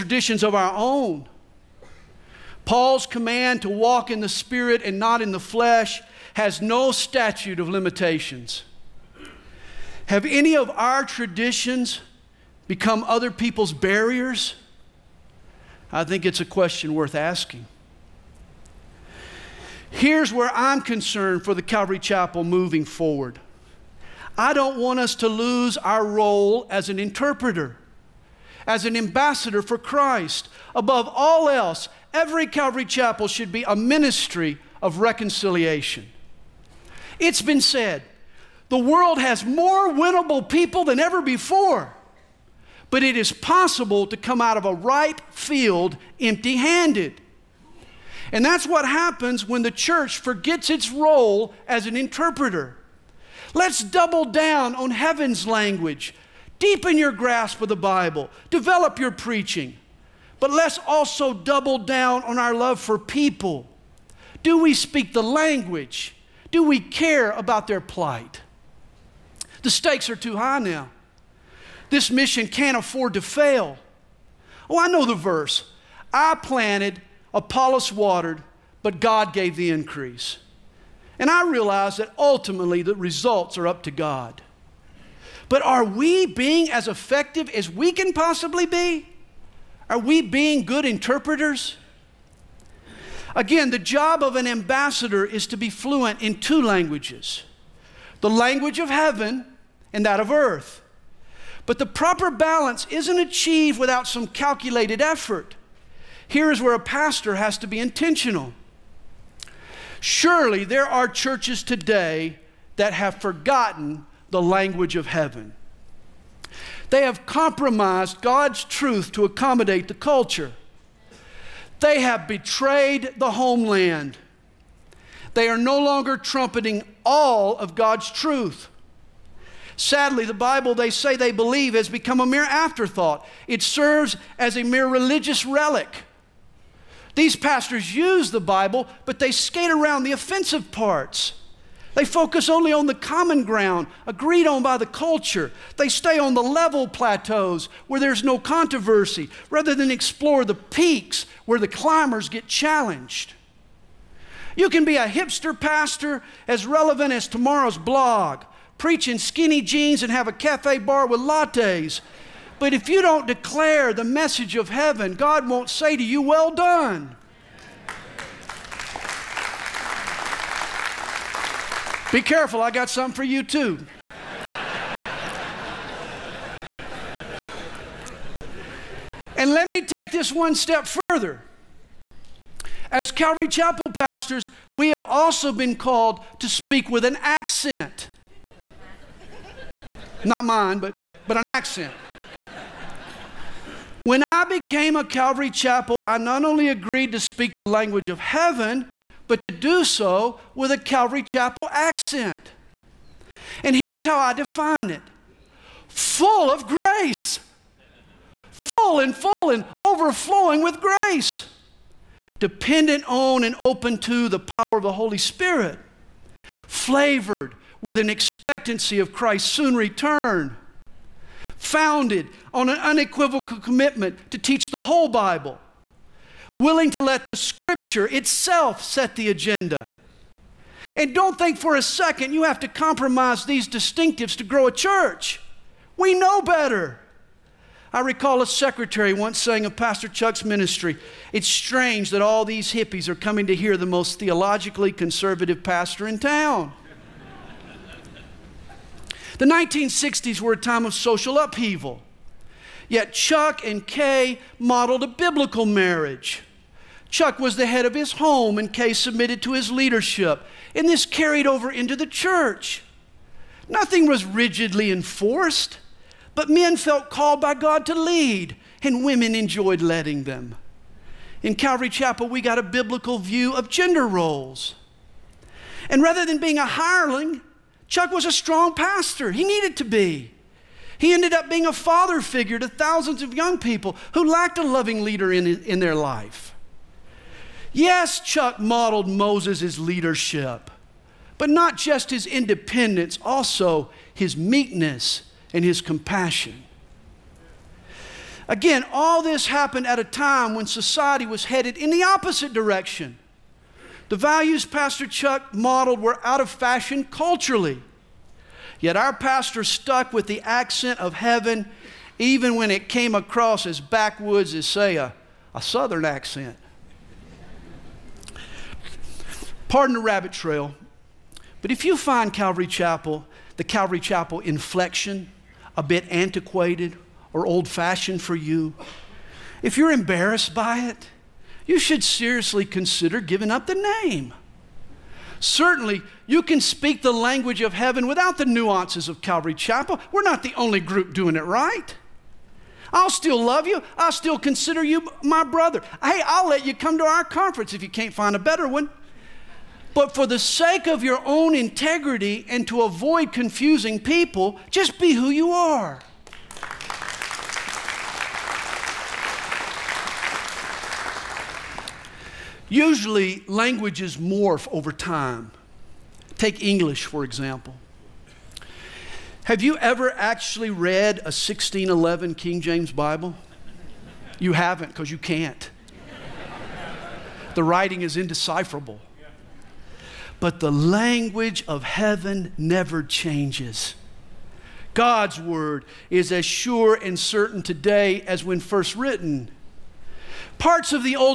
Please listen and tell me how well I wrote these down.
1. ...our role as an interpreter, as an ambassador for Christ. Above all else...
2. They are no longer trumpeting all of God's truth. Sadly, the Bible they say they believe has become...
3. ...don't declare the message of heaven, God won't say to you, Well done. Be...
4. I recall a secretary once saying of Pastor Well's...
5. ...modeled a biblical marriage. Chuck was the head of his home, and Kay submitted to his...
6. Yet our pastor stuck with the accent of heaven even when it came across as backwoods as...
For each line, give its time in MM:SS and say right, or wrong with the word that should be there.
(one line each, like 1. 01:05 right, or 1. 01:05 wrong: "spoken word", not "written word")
1. 00:25 right
2. 02:05 right
3. 02:43 right
4. 03:57 wrong: "Chuck", not "Well"
5. 04:14 right
6. 05:08 right.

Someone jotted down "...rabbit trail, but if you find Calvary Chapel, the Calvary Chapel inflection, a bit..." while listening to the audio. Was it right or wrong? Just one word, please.
right.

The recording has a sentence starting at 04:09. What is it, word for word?
The 1960s were a time of social upheaval.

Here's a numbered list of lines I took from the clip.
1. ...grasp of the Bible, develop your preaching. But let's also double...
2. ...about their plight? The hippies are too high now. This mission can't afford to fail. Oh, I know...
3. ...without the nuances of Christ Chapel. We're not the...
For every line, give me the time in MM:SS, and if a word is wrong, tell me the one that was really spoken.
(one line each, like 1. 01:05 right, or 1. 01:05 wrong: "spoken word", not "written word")
1. 00:57 right
2. 01:07 wrong: "stakes", not "hippies"
3. 05:38 wrong: "Calvary", not "Christ".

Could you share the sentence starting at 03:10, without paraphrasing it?
Not mine, but, but an accent.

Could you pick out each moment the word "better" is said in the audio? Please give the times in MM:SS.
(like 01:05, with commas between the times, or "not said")
03:56, 05:48.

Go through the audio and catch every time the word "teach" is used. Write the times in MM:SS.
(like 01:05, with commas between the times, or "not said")
03:44.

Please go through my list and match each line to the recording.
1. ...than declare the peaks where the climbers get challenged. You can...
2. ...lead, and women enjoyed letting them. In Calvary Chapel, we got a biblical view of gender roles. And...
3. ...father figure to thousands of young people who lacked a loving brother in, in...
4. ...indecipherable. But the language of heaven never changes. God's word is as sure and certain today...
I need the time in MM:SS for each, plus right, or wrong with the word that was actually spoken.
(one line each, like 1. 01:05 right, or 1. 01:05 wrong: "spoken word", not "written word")
1. 02:29 wrong: "explore", not "declare"
2. 04:27 right
3. 04:41 wrong: "leader", not "brother"
4. 06:18 right.